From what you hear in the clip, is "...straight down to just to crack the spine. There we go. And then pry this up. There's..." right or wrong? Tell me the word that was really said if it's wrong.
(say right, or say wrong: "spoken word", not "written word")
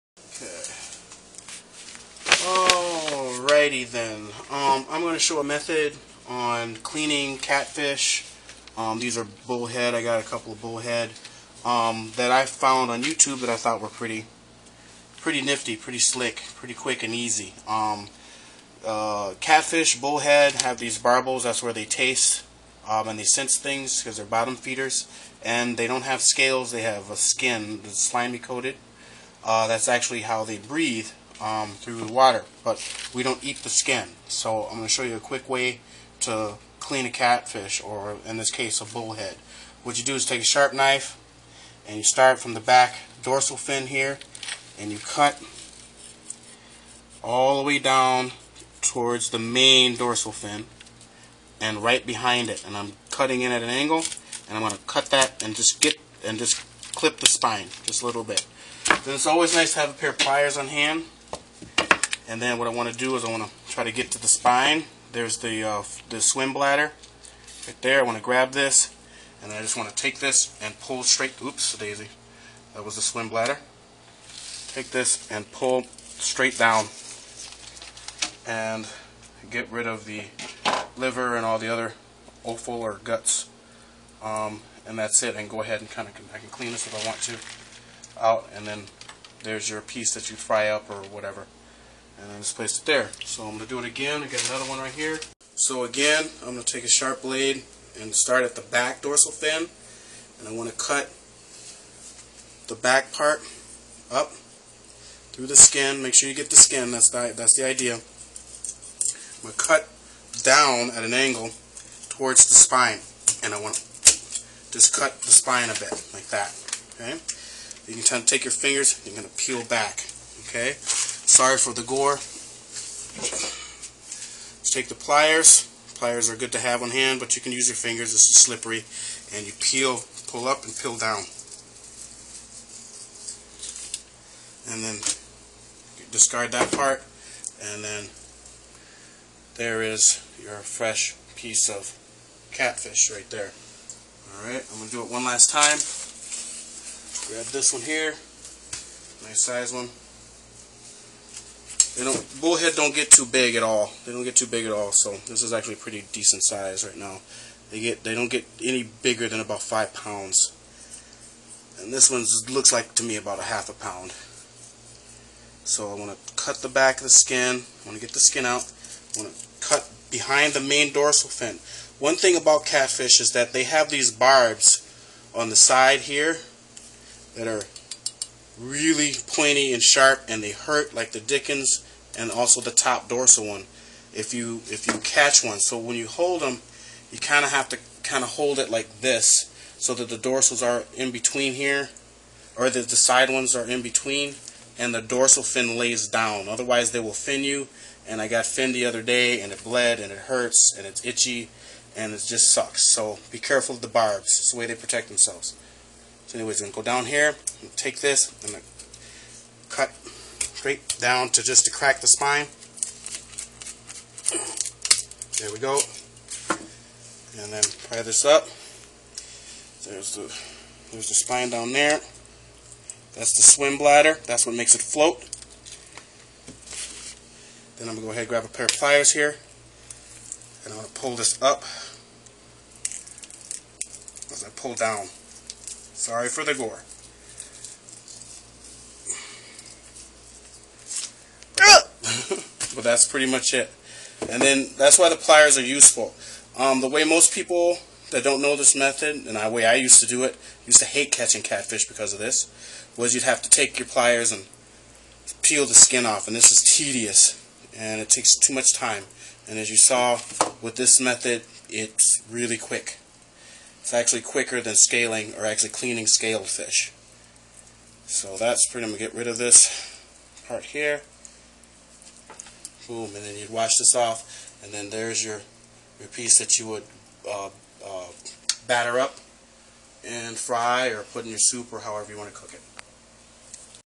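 right.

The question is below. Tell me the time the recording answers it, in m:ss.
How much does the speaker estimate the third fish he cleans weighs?
2:43.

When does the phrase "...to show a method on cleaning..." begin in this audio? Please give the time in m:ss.
0:05.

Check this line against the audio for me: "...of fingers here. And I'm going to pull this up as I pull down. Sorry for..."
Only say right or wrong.
wrong.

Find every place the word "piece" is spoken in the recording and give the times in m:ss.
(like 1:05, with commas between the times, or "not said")
1:29, 2:21, 4:36.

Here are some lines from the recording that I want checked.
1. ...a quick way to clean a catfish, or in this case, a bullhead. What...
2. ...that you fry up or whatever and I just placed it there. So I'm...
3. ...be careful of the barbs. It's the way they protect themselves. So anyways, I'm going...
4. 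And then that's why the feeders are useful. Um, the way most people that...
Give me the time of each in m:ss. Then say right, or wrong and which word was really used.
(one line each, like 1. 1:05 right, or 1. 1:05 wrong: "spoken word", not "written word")
1. 0:35 right
2. 1:30 right
3. 3:23 right
4. 4:04 wrong: "pliers", not "feeders".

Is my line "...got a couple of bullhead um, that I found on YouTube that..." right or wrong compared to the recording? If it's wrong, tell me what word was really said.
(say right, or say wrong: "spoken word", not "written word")
right.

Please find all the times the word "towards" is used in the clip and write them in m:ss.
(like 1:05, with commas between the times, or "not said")
0:48, 1:52.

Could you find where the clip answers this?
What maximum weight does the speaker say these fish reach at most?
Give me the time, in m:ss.
2:39.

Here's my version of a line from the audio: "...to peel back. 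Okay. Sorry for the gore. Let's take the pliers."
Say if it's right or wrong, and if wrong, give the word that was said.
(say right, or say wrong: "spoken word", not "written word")
right.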